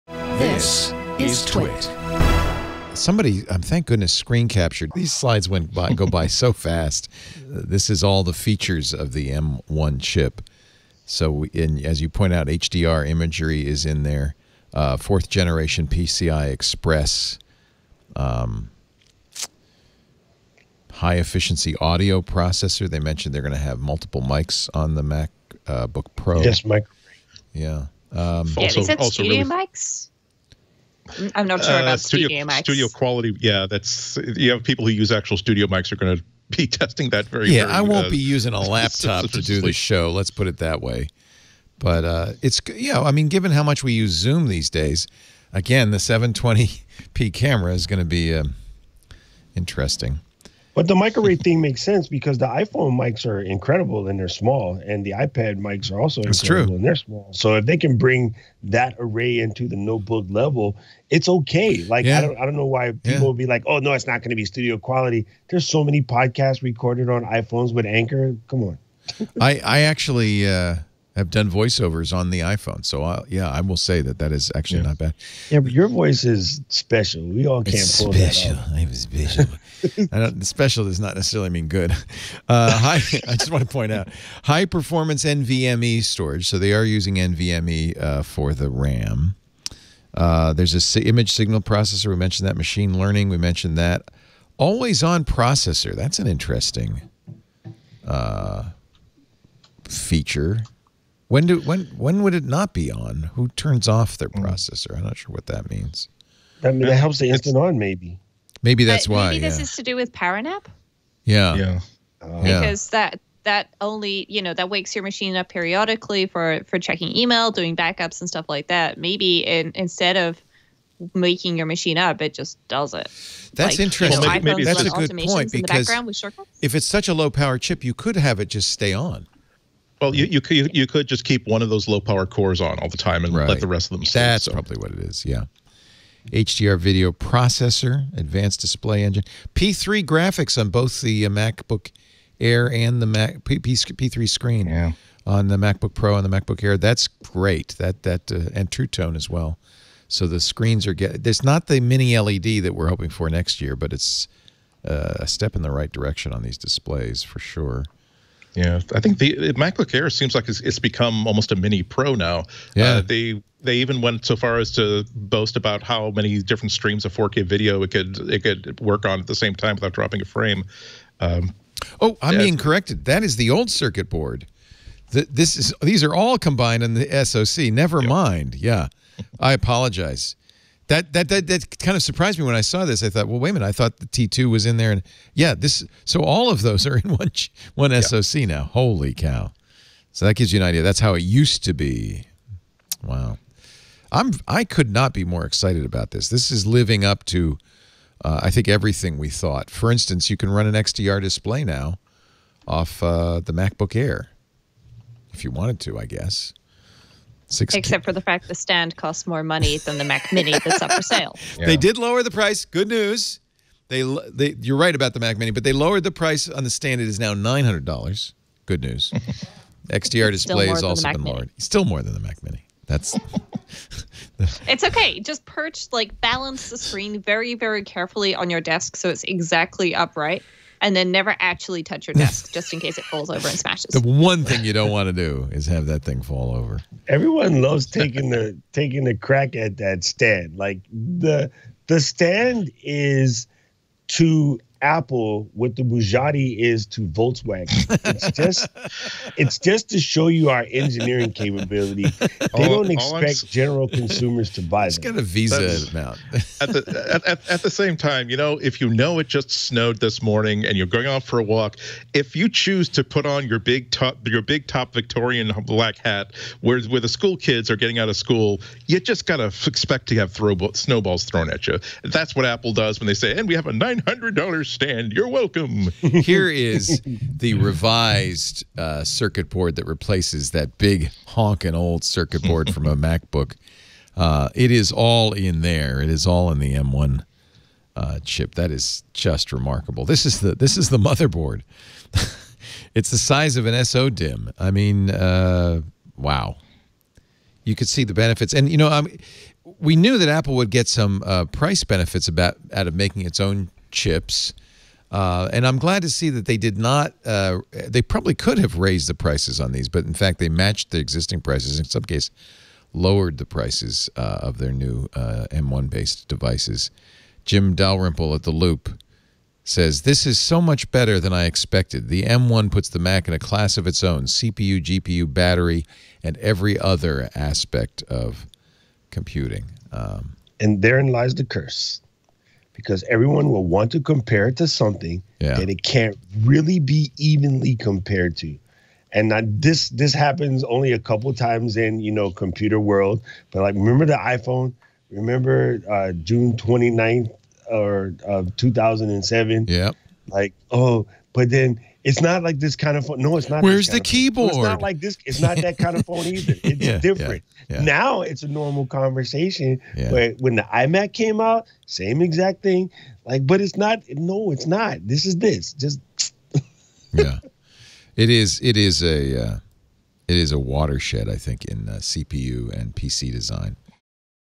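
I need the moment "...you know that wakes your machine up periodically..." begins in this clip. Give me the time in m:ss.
1:54.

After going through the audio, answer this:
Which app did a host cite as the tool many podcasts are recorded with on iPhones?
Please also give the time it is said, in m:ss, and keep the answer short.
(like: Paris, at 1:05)
Anchor, at 1:07.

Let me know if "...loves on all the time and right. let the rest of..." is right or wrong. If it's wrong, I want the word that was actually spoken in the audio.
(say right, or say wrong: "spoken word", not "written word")
wrong: "cores", not "loves".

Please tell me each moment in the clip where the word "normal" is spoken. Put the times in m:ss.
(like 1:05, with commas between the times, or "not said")
5:58.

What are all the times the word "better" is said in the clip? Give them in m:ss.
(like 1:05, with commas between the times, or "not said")
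5:20.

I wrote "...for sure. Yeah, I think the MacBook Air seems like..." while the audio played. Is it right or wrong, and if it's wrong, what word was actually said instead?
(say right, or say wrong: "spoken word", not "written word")
right.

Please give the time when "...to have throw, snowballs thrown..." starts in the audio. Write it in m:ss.
4:30.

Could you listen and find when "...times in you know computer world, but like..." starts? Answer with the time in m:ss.
5:41.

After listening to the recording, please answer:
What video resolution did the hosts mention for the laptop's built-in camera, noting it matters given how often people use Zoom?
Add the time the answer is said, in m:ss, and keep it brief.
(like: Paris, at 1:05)
720p, at 0:45.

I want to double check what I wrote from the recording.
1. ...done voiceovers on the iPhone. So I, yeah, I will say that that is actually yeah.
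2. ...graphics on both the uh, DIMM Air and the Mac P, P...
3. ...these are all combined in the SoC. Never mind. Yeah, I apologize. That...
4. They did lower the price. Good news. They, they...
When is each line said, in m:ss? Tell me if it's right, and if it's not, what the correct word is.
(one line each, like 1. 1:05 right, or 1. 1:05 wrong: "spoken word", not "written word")
1. 1:11 right
2. 2:20 wrong: "MacBook", not "DIMM"
3. 2:55 right
4. 3:31 right.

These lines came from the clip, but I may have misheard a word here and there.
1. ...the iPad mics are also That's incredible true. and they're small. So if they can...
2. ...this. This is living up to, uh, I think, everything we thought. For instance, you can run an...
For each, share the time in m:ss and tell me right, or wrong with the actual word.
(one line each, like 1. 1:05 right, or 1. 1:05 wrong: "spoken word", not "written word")
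1. 0:55 right
2. 3:16 right.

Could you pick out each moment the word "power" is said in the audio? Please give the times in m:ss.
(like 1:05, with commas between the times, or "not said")
1:50, 2:07, 2:11.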